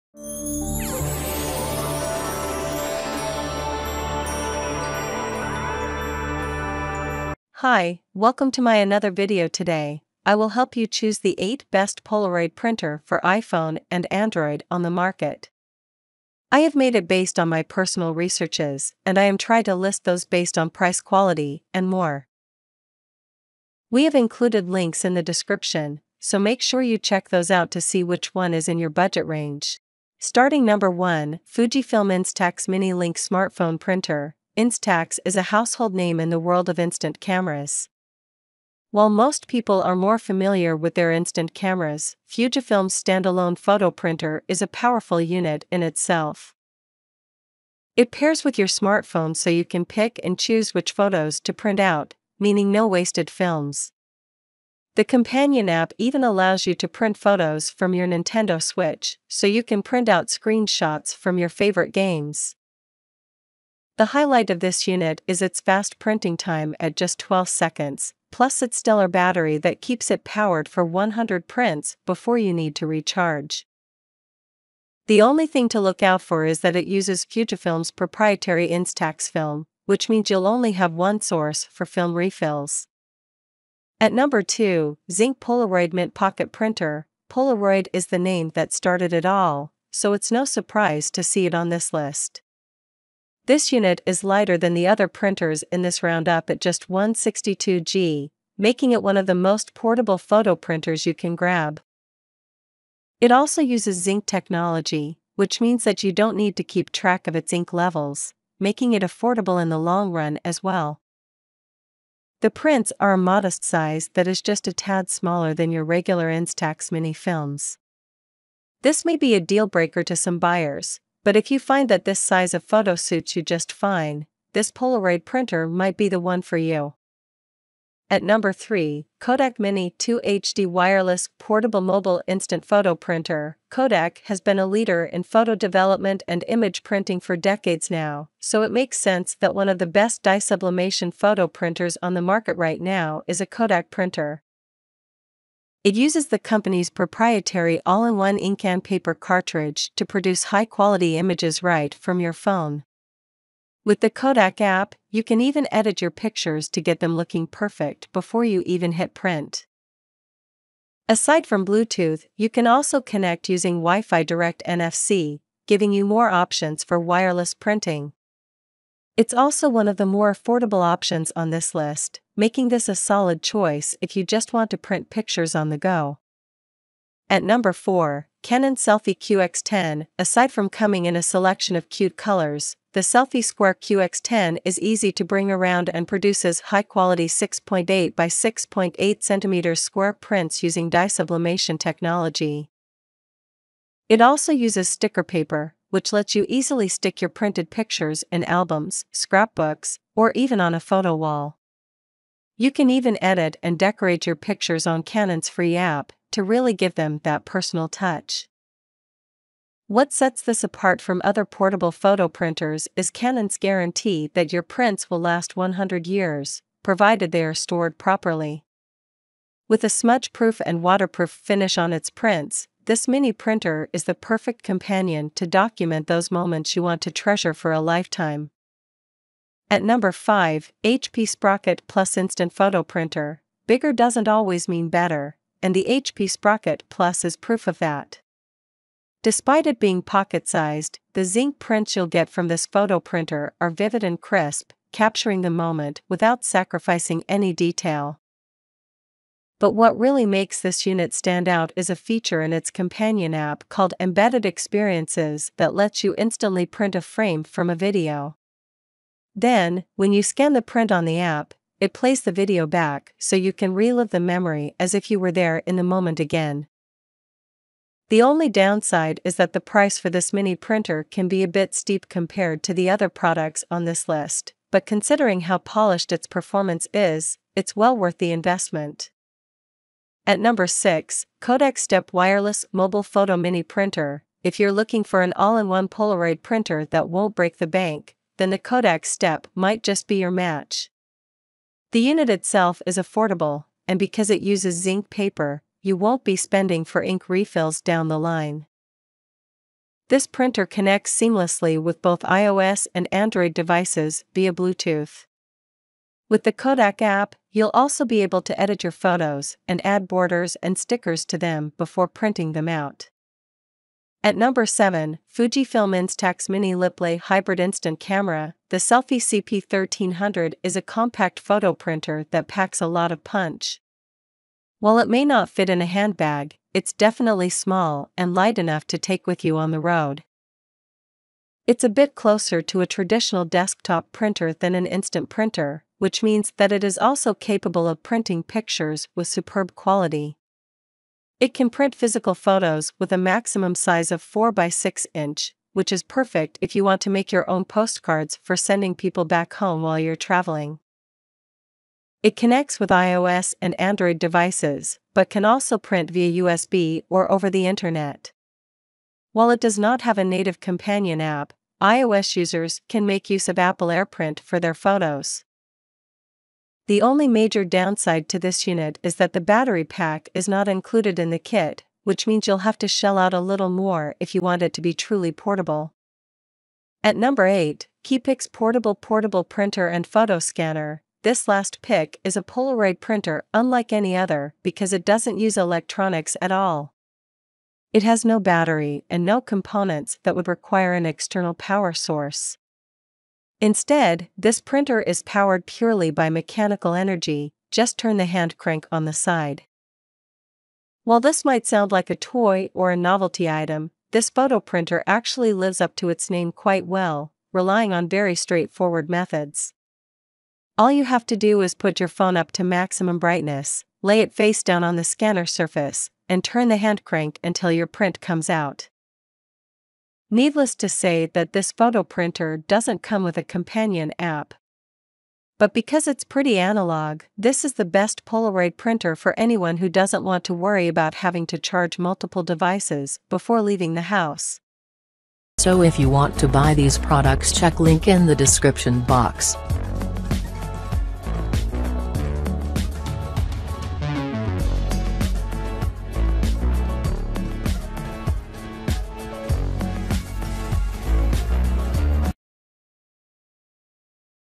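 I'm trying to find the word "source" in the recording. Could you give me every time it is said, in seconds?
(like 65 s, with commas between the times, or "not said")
81 s, 391 s.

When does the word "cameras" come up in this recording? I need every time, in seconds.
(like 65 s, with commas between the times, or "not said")
37 s, 41 s, 317 s.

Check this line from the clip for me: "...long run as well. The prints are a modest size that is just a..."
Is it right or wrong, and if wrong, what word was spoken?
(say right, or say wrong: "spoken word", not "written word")
right.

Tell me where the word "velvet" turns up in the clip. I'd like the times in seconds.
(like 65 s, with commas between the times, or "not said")
not said.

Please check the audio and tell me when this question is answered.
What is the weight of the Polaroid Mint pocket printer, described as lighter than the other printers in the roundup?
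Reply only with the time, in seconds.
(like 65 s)
96 s.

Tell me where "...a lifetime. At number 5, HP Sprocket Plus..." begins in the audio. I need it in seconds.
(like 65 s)
227 s.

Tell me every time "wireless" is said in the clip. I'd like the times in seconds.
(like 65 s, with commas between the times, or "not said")
130 s, 166 s, 282 s.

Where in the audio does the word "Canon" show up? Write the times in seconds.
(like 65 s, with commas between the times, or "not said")
178 s, 205 s, 213 s.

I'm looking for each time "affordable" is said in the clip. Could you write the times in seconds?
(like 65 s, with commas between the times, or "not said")
109 s, 170 s, 292 s.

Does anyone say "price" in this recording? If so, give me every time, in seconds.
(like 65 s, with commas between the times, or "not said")
20 s, 269 s.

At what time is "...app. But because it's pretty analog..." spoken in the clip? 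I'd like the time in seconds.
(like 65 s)
424 s.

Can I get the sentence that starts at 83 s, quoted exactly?
At number 2, Zink Polaroid Mint Pocket Printer.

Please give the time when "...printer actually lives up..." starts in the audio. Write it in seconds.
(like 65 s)
404 s.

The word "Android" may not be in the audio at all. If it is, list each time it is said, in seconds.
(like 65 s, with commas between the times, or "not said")
14 s, 303 s, 353 s.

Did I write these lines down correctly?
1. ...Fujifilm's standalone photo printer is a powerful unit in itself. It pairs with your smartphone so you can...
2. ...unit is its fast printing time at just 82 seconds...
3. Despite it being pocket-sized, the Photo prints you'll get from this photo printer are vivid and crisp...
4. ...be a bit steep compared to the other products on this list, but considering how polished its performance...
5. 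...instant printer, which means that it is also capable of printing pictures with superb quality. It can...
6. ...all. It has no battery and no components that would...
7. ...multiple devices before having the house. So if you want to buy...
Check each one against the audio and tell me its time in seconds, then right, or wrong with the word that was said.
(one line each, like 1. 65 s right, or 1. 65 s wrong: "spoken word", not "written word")
1. 42 s right
2. 64 s wrong: "12", not "82"
3. 239 s wrong: "Zink", not "Photo"
4. 271 s right
5. 334 s right
6. 386 s right
7. 431 s wrong: "leaving", not "having".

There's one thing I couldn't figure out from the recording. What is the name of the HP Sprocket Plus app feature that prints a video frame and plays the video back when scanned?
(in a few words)
Embedded Experiences.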